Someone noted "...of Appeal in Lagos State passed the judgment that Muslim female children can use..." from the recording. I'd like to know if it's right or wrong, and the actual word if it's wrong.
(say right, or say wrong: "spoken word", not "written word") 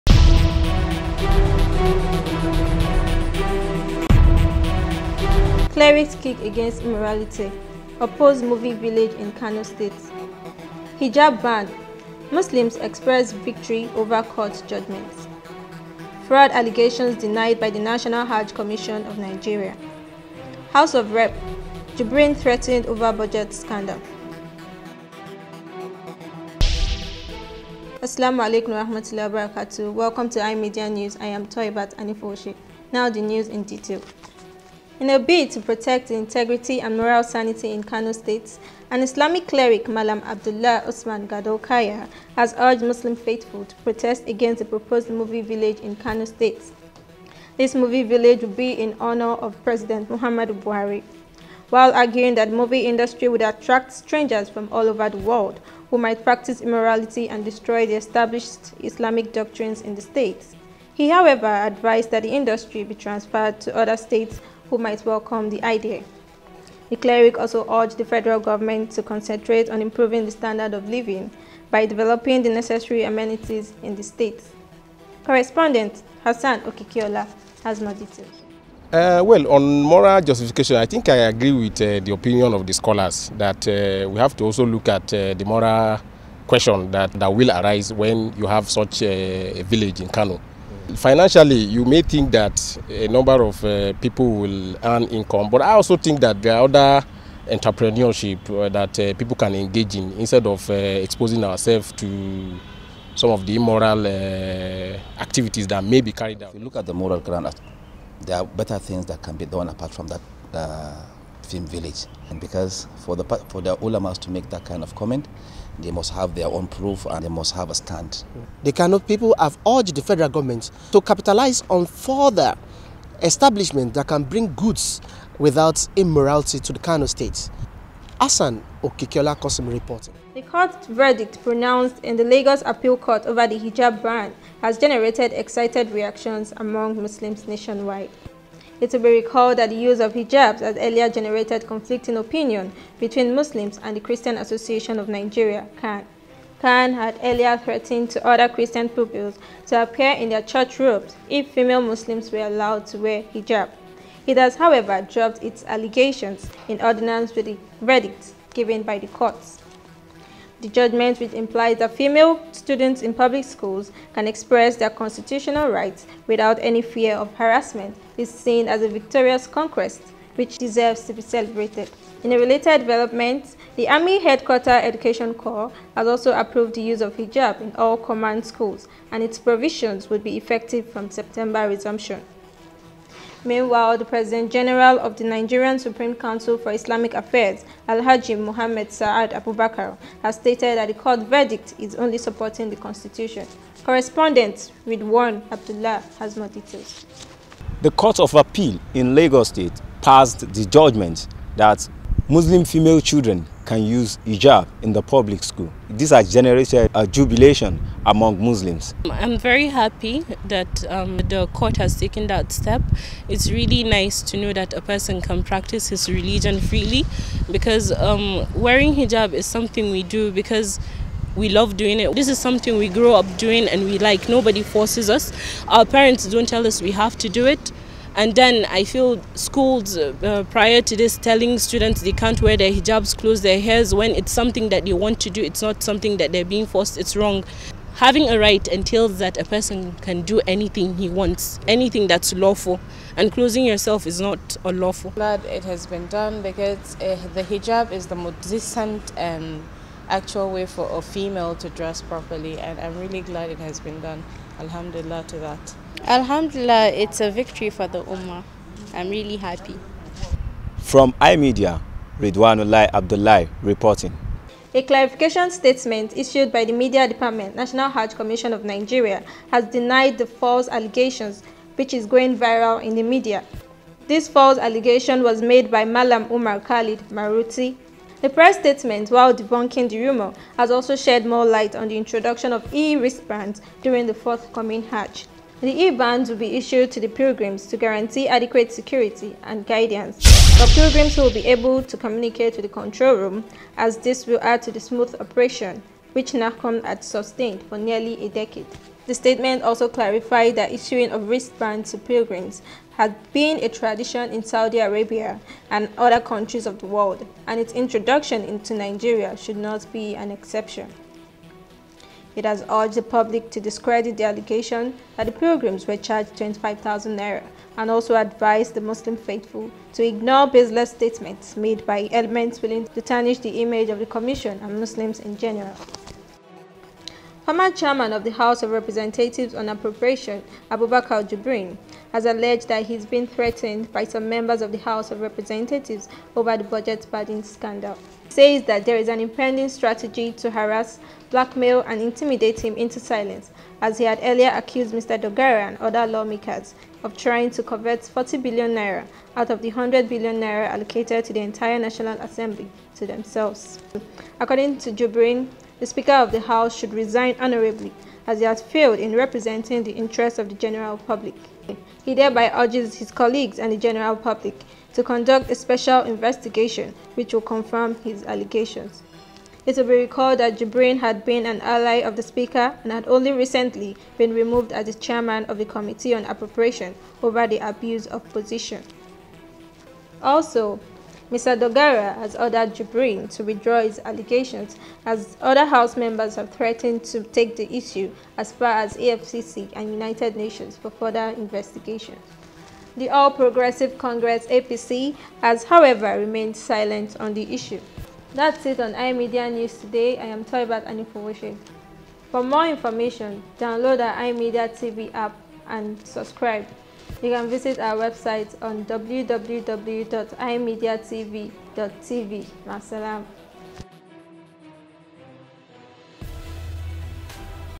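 right.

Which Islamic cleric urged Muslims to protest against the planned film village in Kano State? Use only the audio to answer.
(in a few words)
Abdullah Osman Gadokaya.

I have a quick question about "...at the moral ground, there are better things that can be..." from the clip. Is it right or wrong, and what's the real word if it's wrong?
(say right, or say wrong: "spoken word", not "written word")
right.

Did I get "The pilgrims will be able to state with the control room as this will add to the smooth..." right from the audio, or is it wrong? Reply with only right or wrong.
wrong.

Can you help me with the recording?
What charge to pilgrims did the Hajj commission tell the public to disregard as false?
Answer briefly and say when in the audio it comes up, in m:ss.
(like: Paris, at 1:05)
25,000 naira, at 5:16.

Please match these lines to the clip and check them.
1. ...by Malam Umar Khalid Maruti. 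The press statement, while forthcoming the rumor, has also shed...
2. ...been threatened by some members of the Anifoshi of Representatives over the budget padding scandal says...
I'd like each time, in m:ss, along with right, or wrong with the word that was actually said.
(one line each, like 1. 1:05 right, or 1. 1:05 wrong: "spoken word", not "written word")
1. 4:35 wrong: "debunking", not "forthcoming"
2. 5:33 wrong: "House", not "Anifoshi".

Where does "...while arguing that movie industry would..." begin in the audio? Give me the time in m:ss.
0:51.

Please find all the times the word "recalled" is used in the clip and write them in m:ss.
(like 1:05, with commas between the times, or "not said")
2:19, 6:09.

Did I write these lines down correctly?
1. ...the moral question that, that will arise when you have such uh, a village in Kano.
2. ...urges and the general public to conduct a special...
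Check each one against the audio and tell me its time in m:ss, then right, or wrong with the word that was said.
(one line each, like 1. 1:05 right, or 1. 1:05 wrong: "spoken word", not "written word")
1. 1:25 right
2. 6:03 wrong: "colleagues", not "urges".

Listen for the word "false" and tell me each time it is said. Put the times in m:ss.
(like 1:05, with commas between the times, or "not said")
4:30, 4:34.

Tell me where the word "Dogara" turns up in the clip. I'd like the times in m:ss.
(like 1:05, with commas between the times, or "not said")
5:45, 6:21.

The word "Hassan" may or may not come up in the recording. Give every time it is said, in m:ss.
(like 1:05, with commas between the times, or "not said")
1:16, 2:08.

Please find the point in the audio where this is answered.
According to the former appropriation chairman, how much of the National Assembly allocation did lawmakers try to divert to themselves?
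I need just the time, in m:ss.
5:48.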